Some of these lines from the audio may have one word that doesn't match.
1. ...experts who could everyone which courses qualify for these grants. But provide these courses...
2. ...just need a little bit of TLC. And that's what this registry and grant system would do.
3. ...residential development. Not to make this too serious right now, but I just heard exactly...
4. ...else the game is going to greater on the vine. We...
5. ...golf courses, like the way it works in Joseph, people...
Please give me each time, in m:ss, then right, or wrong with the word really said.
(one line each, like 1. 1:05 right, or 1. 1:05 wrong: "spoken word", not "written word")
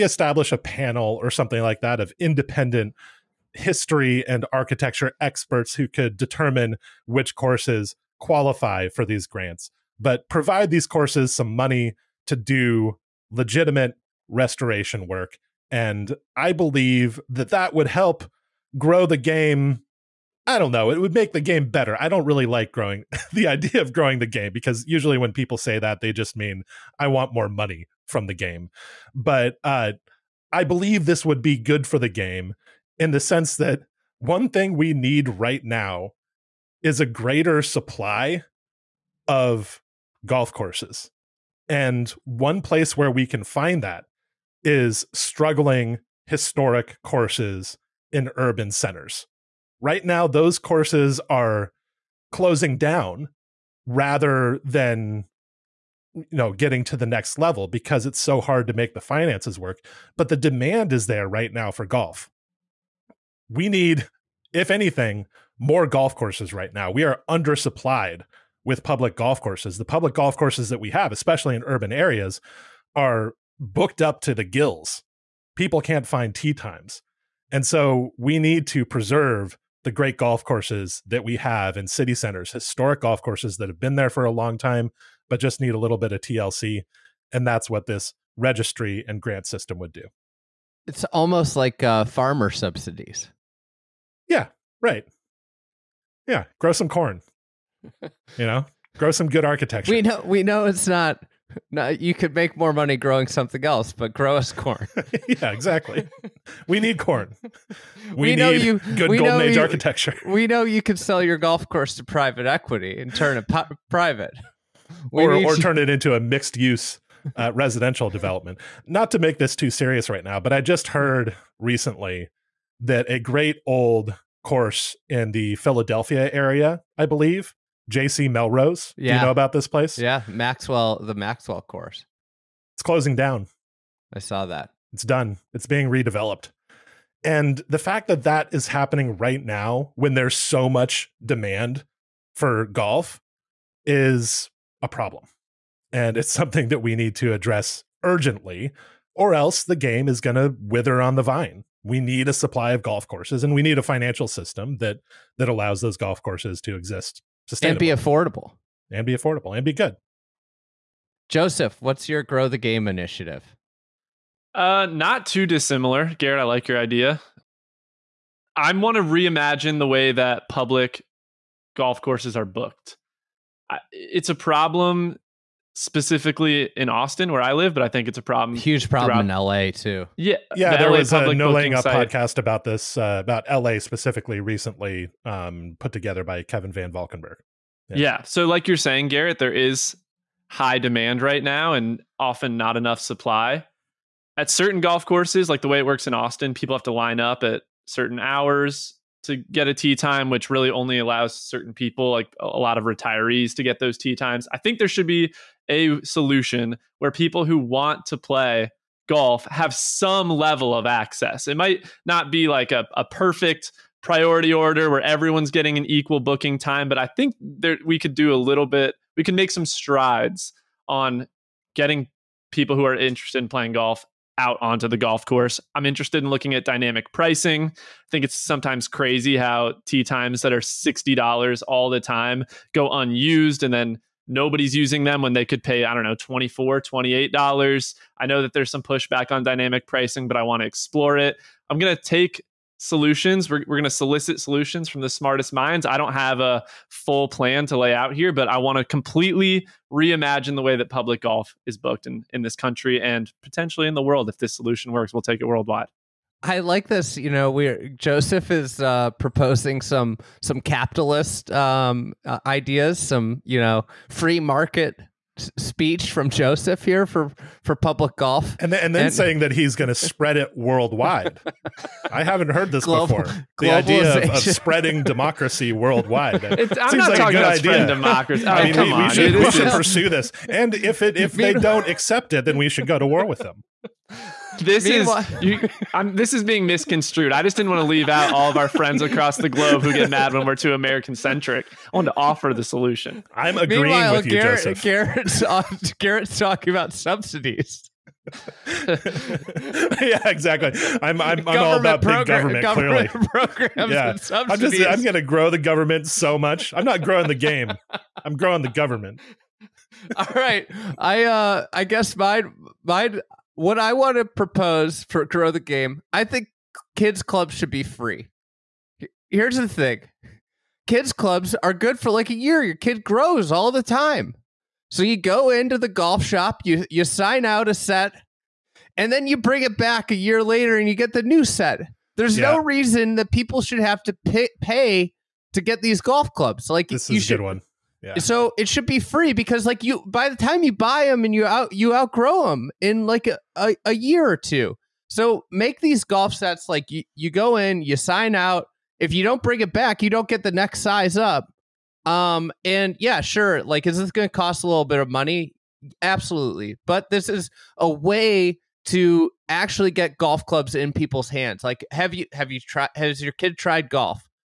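1. 0:05 wrong: "determine", not "everyone"
2. 1:25 right
3. 1:57 wrong: "recently", not "exactly"
4. 2:29 wrong: "wither", not "greater"
5. 3:14 wrong: "Austin", not "Joseph".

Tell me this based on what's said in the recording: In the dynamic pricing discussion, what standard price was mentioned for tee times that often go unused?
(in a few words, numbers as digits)
$60.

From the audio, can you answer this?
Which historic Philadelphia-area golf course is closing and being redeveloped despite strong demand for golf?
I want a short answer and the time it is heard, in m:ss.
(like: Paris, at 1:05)
JC Melrose, at 2:07.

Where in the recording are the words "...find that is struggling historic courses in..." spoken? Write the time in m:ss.
0:43.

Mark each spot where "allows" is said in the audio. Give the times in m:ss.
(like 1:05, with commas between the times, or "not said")
2:35, 3:20.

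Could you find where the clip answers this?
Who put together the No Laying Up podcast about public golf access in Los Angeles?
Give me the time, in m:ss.
3:06.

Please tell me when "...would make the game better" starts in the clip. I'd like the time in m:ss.
0:20.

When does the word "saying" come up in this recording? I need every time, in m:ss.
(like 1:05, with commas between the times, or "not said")
3:08, 4:29.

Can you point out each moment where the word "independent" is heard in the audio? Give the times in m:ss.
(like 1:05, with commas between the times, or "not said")
0:02.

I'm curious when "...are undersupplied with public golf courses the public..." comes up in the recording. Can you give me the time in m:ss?
1:07.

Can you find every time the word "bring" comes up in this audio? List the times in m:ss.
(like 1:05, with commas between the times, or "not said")
5:29, 5:49.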